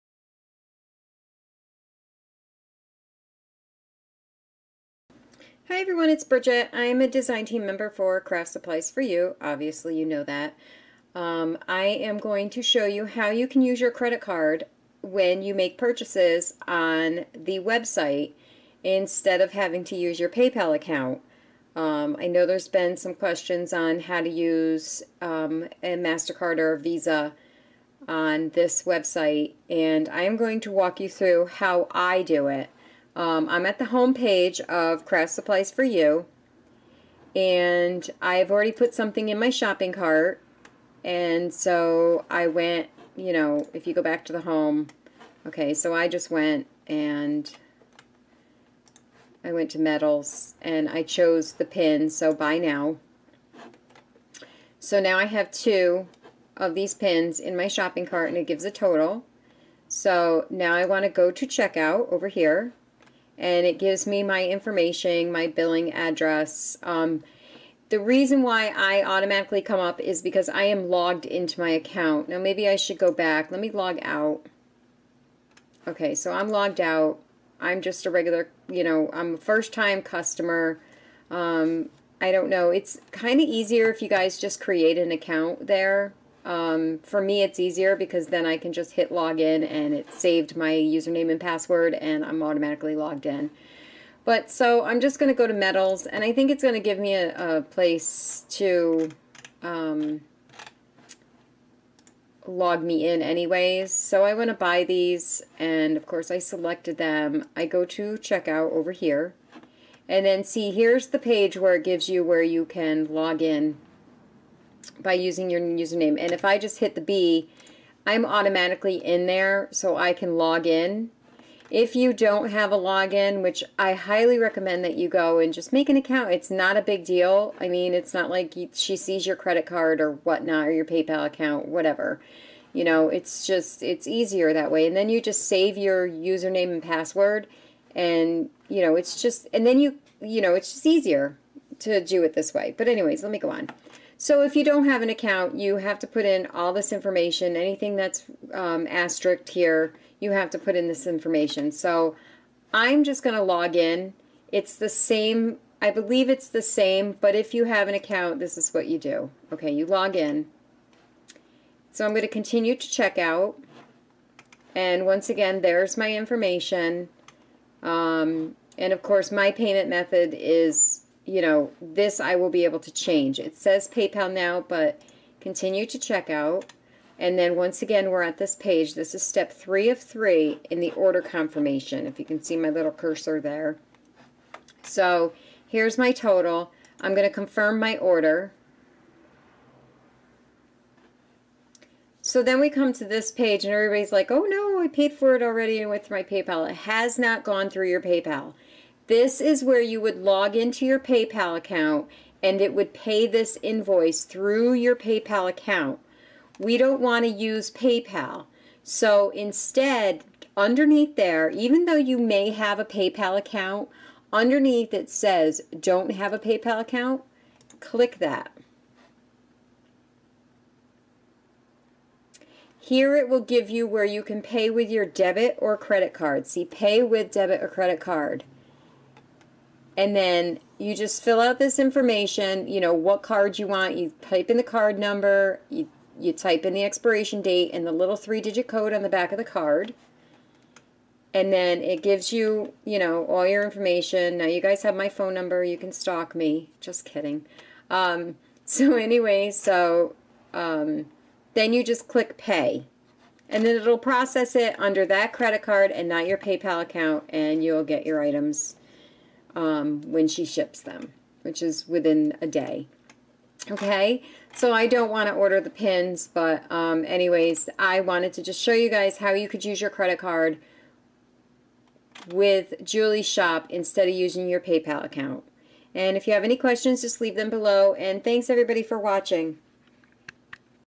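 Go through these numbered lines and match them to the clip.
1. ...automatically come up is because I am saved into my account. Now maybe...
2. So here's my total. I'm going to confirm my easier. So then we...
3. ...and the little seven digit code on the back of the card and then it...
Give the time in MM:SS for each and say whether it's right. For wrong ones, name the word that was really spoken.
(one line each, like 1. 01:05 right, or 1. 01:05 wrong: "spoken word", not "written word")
1. 01:09 wrong: "logged", not "saved"
2. 03:04 wrong: "order", not "easier"
3. 03:57 wrong: "three", not "seven".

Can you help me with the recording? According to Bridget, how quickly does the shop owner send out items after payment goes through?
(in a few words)
within a day.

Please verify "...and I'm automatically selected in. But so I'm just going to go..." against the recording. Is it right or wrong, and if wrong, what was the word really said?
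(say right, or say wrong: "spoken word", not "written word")
wrong: "logged", not "selected".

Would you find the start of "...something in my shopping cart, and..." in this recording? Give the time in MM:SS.
00:38.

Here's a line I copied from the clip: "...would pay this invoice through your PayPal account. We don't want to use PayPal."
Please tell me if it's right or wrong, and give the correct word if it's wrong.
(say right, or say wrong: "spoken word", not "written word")
right.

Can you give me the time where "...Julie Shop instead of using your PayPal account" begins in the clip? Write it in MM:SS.
04:32.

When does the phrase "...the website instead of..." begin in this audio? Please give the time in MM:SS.
00:17.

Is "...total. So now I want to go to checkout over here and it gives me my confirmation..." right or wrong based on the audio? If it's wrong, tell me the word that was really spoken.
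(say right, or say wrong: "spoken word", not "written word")
wrong: "information", not "confirmation".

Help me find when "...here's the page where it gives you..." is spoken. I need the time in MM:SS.
01:50.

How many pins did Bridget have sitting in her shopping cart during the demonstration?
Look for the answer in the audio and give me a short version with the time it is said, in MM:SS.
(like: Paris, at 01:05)
2, at 00:55.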